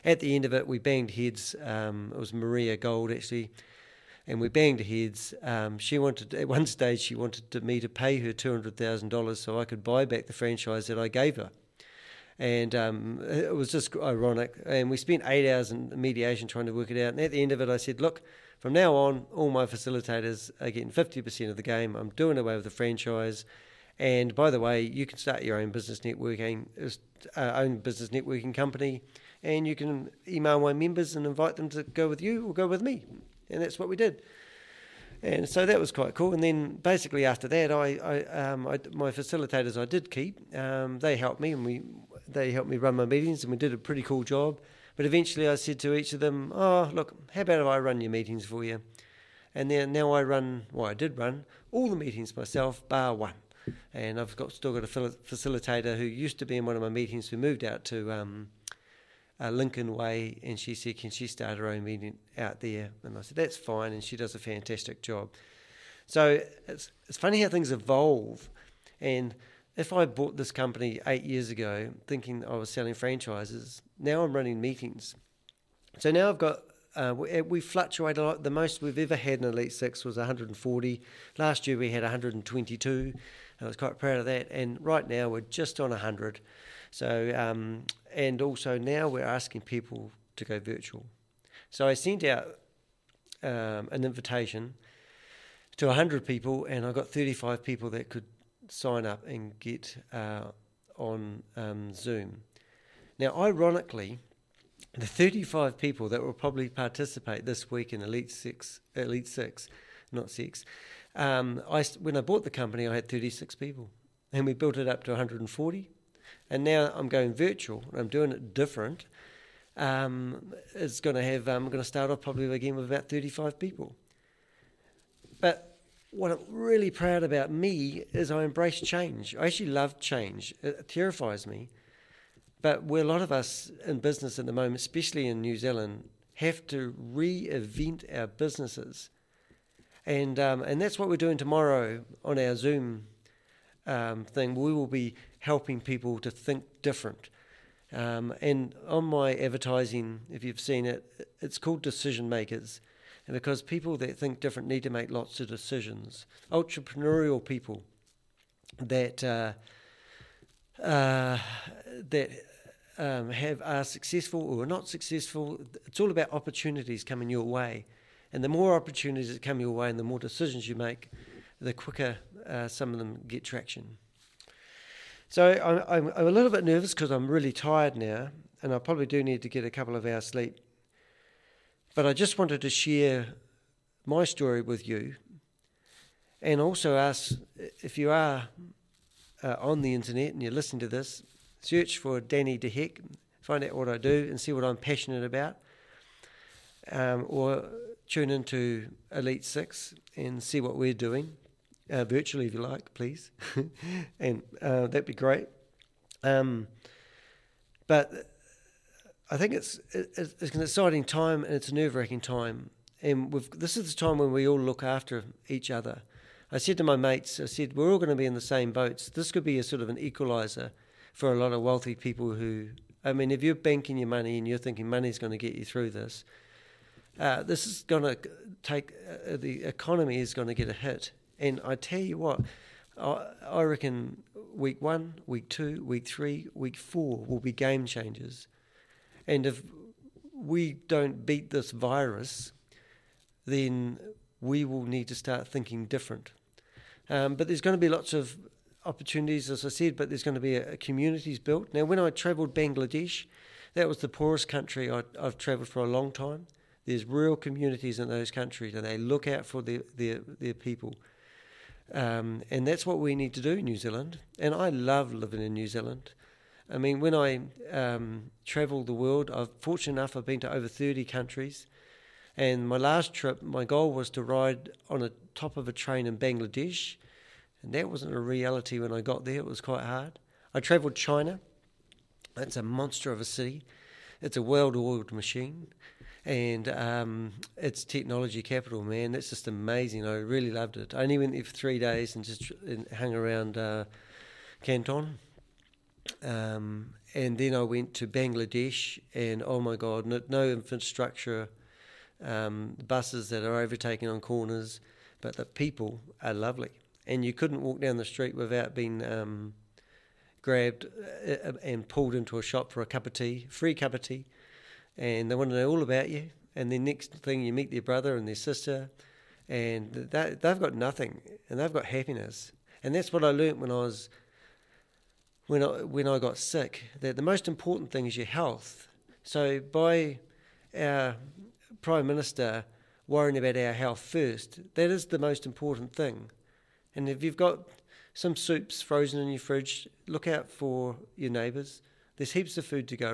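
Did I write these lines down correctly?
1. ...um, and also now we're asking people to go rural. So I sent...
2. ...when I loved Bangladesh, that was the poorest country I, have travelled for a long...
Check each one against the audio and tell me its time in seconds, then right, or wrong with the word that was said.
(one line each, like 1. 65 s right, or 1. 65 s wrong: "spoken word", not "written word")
1. 87 s wrong: "virtual", not "rural"
2. 251 s wrong: "travelled", not "loved".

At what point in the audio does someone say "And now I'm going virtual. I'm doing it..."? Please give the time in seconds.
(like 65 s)
116 s.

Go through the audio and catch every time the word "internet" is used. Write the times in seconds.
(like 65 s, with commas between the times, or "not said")
189 s.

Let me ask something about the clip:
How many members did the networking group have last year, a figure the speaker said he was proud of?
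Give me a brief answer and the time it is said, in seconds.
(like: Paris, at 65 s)
122, at 82 s.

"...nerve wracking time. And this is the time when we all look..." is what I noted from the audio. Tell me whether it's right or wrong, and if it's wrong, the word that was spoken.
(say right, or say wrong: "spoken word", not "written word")
right.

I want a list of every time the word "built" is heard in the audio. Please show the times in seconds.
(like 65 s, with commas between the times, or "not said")
114 s, 251 s.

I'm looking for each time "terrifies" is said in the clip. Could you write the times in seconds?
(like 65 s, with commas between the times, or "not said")
130 s.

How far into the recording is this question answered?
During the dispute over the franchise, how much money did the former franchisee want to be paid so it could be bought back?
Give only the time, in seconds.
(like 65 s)
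8 s.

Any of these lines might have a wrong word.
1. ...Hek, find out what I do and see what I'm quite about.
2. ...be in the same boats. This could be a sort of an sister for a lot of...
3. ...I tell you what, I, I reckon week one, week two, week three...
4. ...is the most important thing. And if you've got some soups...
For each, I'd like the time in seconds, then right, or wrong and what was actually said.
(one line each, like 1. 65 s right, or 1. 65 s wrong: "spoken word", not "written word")
1. 192 s wrong: "passionate", not "quite"
2. 218 s wrong: "equalizer", not "sister"
3. 231 s right
4. 334 s right.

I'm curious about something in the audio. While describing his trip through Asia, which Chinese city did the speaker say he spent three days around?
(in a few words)
Canton.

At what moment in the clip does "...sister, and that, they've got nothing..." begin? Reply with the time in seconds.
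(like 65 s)
318 s.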